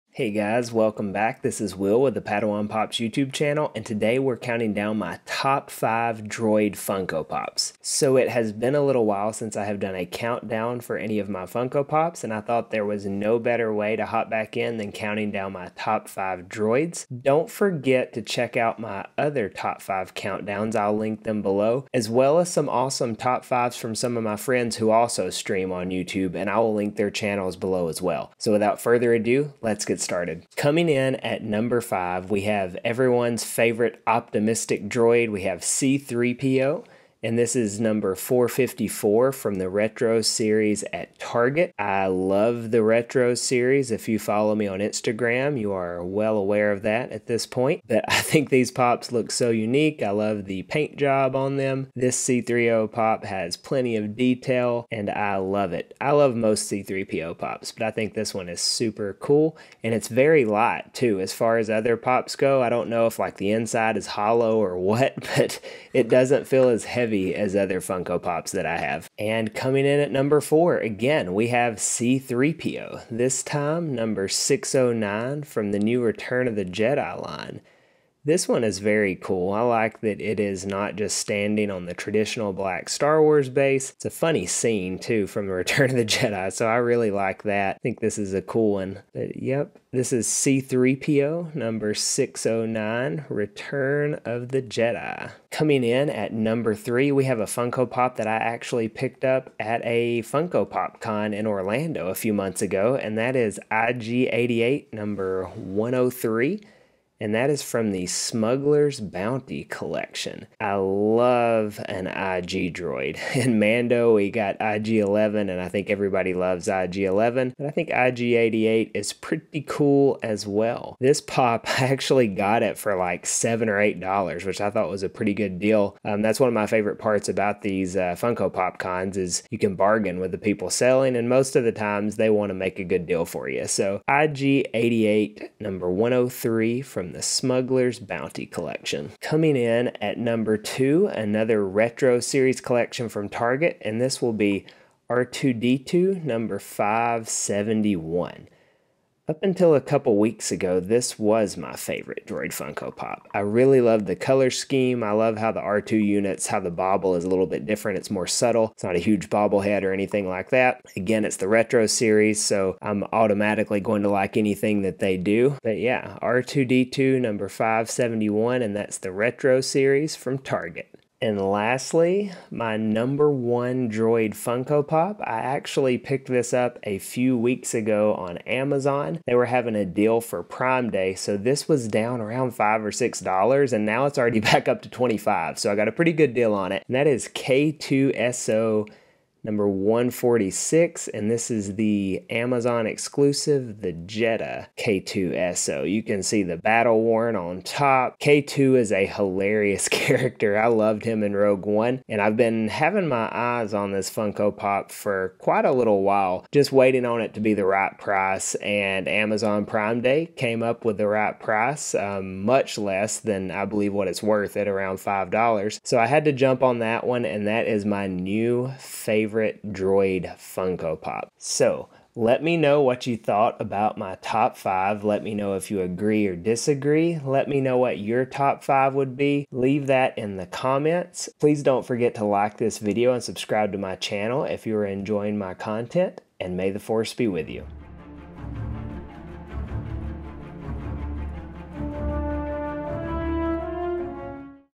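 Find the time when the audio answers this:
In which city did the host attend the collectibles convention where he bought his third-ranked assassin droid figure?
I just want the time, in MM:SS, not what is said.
01:41.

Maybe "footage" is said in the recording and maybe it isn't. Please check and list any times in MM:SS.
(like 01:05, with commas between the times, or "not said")
not said.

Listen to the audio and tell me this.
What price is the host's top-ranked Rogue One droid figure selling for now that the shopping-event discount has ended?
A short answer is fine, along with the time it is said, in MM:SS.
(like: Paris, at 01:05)
$25, at 03:04.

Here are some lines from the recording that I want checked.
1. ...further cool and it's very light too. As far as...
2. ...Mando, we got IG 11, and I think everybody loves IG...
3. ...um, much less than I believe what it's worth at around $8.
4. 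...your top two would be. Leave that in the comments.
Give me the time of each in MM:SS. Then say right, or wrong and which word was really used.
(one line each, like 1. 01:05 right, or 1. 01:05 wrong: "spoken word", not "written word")
1. 00:58 wrong: "super", not "further"
2. 01:53 right
3. 03:31 wrong: "5", not "8"
4. 03:47 wrong: "five", not "two".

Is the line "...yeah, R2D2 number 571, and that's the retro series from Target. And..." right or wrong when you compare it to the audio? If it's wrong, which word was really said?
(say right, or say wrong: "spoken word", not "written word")
right.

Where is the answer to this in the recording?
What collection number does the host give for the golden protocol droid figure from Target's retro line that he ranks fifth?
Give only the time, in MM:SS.
00:38.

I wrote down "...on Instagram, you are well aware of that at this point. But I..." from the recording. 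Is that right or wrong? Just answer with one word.
right.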